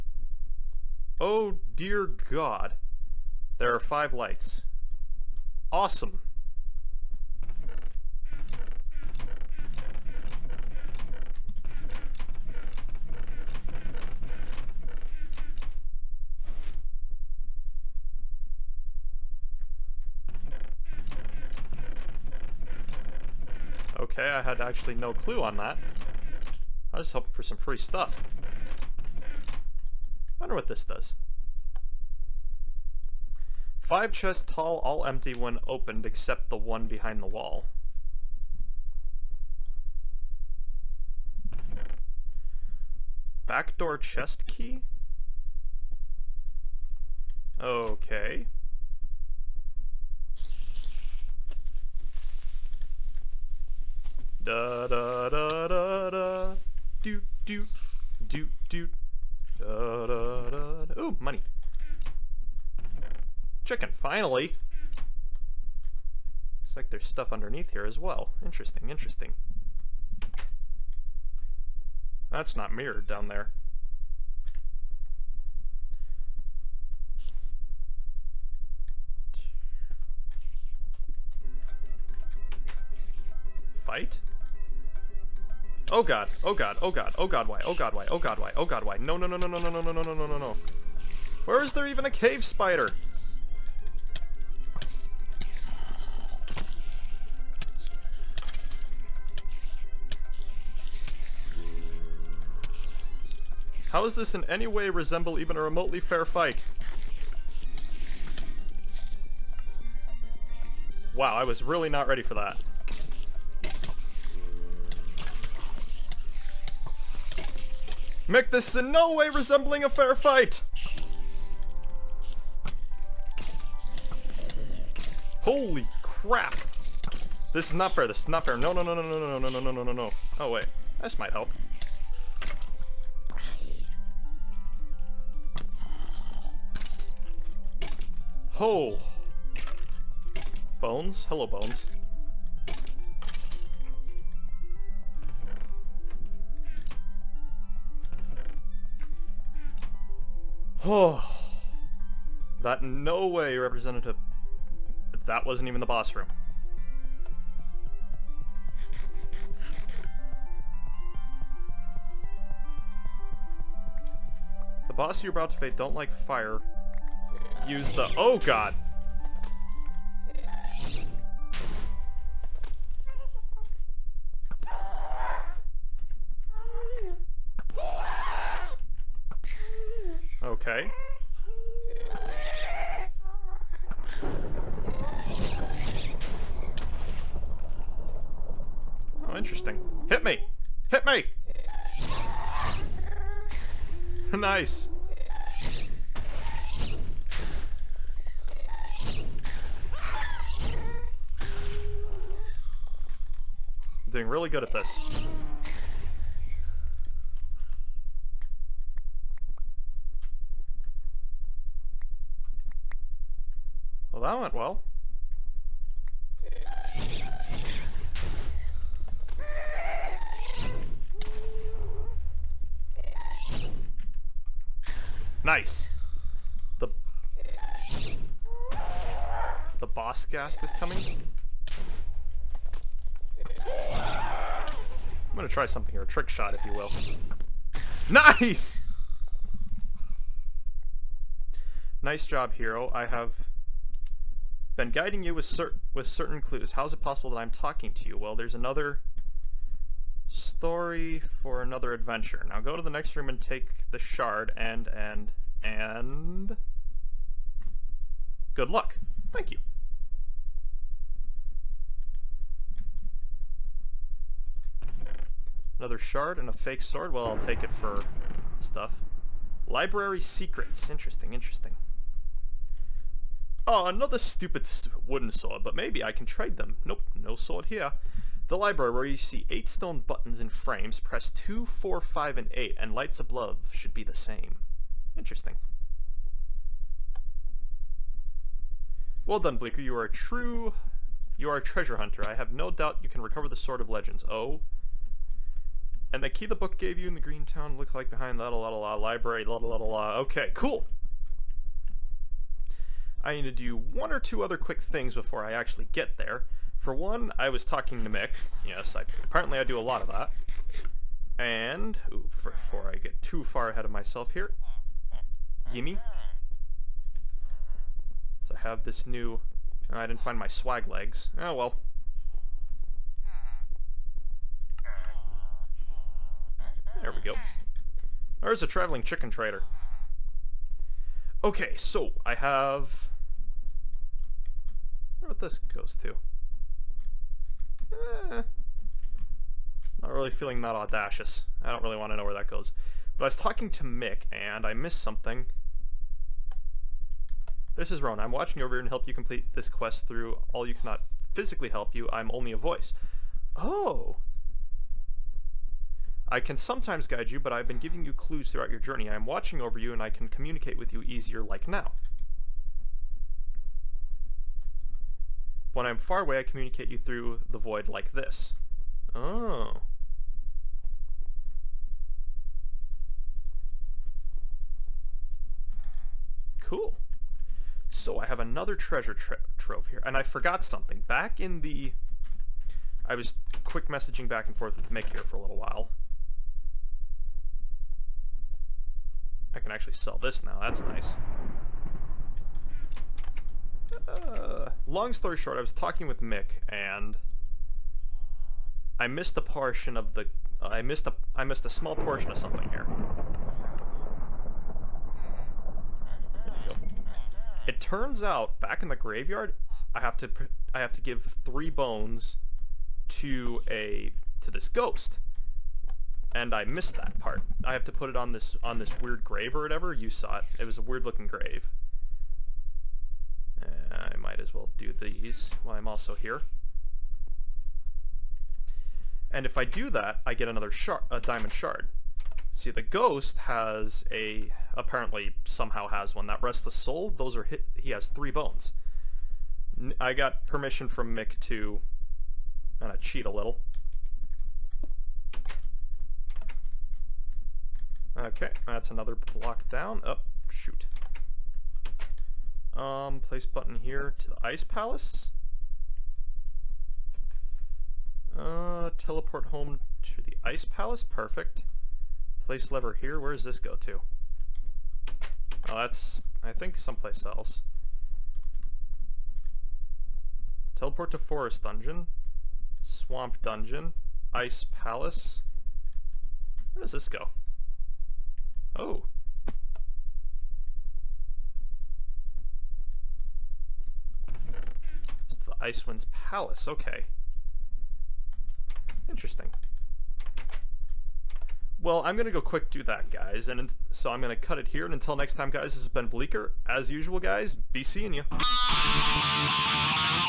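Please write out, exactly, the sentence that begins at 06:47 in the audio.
It turns out, back in the graveyard, I have to.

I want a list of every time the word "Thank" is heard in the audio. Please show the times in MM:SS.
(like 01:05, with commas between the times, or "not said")
04:19.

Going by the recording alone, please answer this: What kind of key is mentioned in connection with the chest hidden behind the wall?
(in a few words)
Backdoor chest key.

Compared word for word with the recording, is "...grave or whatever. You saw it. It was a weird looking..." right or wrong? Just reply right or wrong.
right.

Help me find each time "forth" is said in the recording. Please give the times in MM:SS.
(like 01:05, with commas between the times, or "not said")
06:24.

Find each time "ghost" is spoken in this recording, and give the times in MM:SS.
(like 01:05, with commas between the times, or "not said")
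06:54, 07:12.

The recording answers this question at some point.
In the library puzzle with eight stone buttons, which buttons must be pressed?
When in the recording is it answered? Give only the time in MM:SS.
04:41.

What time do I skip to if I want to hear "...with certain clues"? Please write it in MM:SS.
04:05.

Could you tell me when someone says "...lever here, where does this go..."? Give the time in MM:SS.
07:42.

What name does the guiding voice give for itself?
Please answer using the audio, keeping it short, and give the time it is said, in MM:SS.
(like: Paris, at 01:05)
Ron, at 05:48.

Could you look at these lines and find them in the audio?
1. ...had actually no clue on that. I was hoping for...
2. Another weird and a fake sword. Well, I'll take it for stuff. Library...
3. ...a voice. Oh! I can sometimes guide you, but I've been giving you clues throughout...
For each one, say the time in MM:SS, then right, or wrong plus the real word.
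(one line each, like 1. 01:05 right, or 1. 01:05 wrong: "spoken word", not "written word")
1. 00:24 right
2. 04:25 wrong: "shard", not "weird"
3. 05:52 right.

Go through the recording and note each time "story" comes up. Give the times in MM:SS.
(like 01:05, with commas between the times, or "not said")
04:10, 06:35.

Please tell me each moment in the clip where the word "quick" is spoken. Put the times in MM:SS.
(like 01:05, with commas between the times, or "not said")
05:04, 06:23, 08:12.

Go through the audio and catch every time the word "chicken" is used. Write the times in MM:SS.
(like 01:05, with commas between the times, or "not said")
01:03, 05:29.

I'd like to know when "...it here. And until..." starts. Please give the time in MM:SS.
08:14.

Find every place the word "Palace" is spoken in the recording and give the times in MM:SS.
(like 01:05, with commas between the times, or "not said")
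07:34, 07:40, 07:54, 08:06.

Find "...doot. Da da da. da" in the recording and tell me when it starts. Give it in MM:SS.
00:58.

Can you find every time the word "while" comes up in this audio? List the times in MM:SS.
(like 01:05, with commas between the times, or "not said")
06:25, 07:05.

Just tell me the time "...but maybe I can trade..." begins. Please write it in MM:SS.
04:35.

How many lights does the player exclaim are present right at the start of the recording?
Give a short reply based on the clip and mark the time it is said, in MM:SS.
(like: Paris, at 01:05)
5, at 00:03.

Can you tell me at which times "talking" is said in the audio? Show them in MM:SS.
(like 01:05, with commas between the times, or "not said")
04:07, 05:07, 05:43, 06:35.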